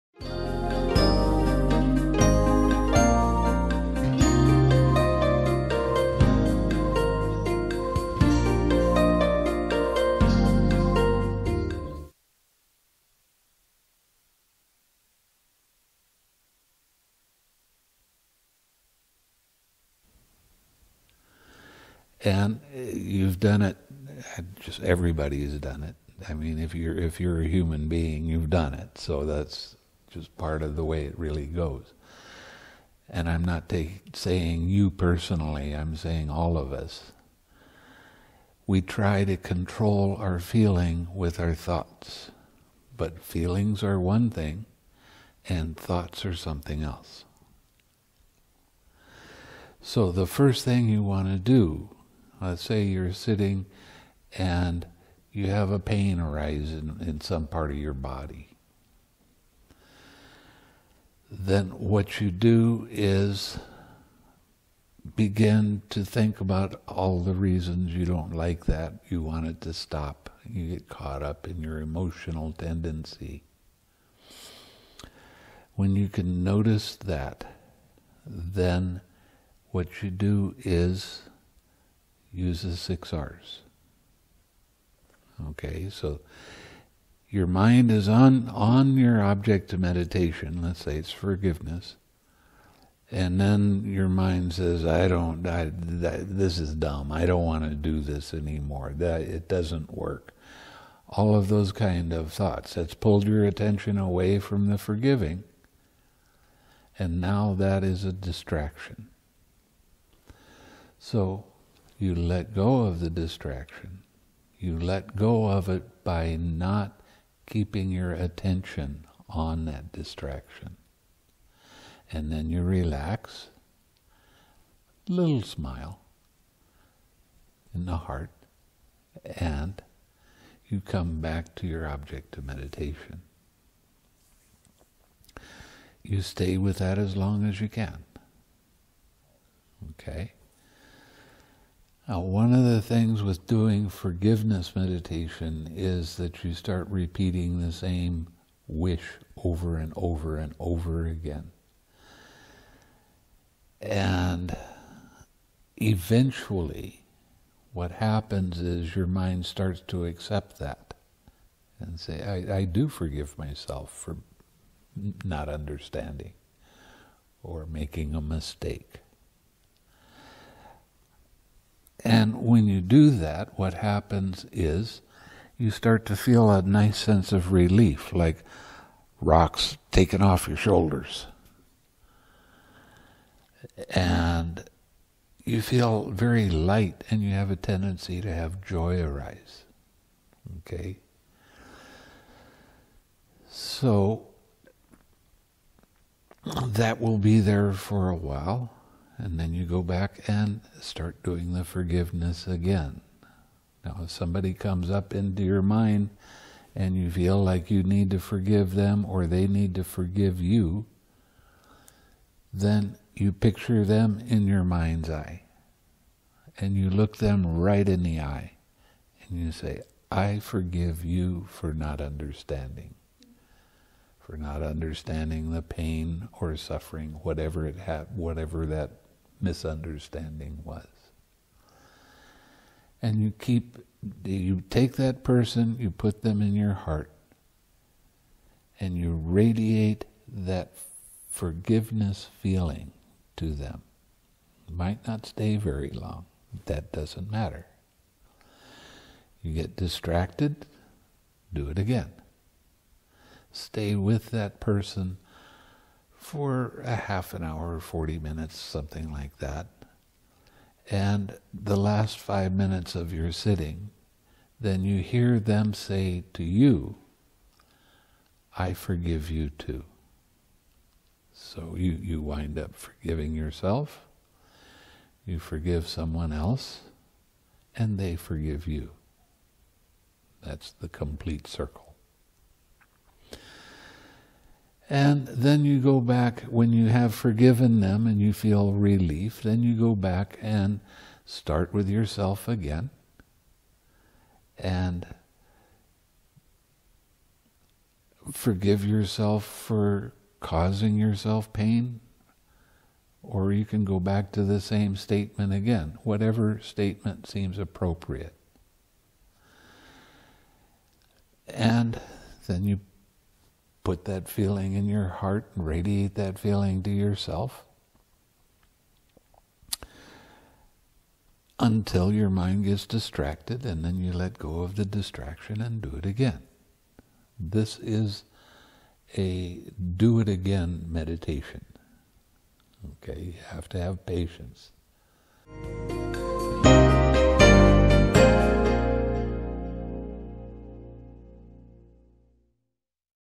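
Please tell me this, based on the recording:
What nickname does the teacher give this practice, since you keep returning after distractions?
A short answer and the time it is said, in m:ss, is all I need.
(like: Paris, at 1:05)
do it again meditation, at 5:29.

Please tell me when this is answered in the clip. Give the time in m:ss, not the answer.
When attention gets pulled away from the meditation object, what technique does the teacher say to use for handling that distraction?
1:22.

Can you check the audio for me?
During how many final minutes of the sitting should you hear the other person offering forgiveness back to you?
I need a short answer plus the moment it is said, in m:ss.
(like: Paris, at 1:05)
5, at 4:22.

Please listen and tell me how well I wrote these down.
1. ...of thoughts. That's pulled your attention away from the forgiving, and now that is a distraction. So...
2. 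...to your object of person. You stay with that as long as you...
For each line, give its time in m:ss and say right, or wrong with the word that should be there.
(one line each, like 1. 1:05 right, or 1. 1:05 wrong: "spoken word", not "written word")
1. 1:42 right
2. 2:11 wrong: "meditation", not "person".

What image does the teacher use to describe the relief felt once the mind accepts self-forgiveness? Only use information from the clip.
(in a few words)
rocks taken off your shoulders.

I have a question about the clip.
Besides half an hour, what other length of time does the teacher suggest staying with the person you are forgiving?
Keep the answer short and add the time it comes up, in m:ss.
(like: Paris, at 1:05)
40 minutes, at 4:17.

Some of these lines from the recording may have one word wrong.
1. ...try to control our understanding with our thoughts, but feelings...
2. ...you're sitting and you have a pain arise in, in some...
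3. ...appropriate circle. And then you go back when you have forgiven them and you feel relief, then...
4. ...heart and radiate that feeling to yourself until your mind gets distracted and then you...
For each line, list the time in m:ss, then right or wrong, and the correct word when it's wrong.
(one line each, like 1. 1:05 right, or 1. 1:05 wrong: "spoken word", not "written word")
1. 0:38 wrong: "feeling", not "understanding"
2. 0:52 right
3. 4:40 wrong: "complete", not "appropriate"
4. 5:15 right.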